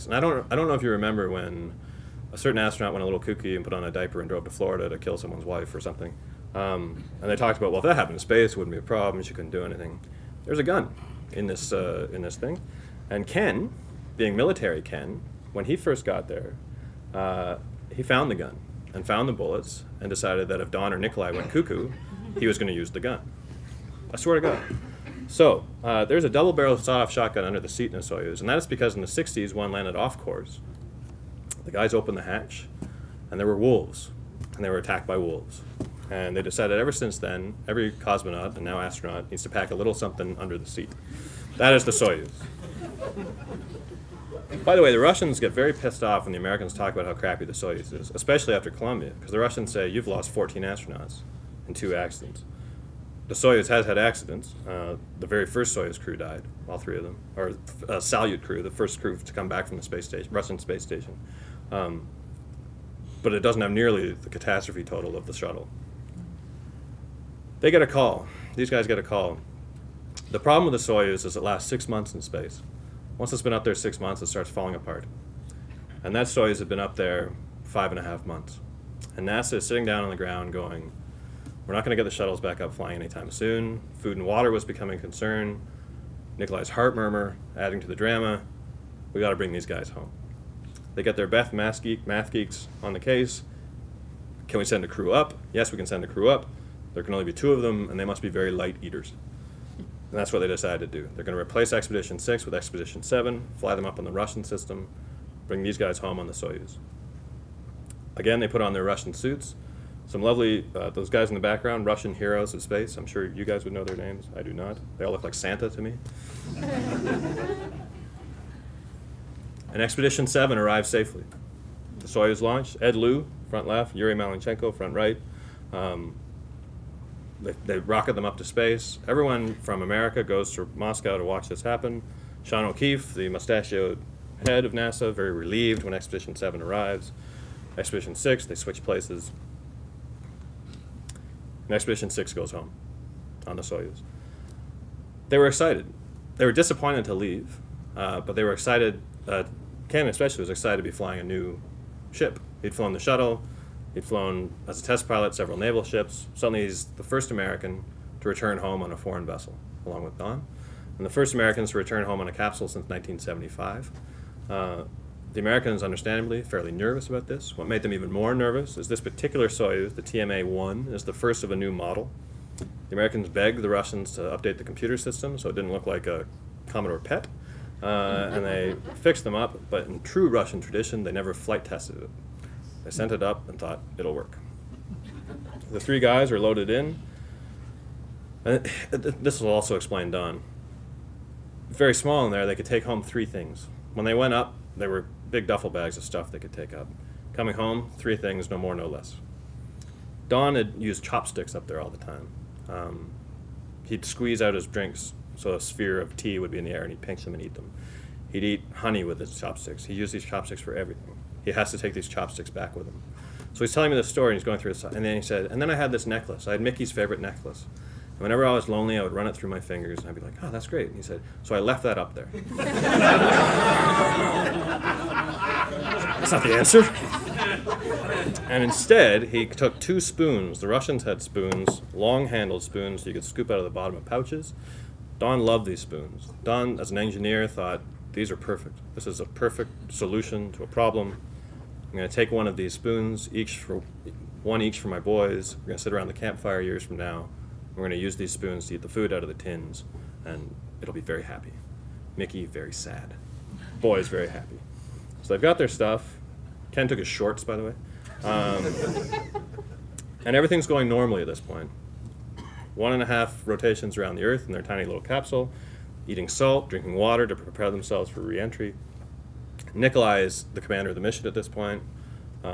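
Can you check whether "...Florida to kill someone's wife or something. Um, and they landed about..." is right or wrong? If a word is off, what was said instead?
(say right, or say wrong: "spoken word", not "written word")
wrong: "talked", not "landed".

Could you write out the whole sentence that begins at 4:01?
I'm going to take one of these spoons, each for one each for my boys.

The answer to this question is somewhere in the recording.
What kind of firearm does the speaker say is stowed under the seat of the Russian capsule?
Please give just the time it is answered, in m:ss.
0:26.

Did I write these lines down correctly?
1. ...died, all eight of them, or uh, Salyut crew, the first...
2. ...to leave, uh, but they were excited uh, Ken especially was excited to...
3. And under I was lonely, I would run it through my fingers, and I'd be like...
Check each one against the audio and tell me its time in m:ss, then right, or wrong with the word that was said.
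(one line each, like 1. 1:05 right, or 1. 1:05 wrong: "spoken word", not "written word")
1. 0:56 wrong: "three", not "eight"
2. 2:27 right
3. 3:38 wrong: "whenever", not "under".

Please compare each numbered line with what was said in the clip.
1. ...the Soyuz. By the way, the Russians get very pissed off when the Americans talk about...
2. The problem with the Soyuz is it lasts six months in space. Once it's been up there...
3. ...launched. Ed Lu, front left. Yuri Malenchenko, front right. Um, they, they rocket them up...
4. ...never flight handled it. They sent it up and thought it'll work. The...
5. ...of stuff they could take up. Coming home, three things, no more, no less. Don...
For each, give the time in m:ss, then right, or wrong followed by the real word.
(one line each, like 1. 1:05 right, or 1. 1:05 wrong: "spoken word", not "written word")
1. 0:41 right
2. 1:10 right
3. 2:02 right
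4. 3:01 wrong: "tested", not "handled"
5. 3:15 right.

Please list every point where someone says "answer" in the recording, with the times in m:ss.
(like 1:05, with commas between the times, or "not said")
3:46.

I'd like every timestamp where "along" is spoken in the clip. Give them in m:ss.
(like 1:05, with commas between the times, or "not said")
2:39.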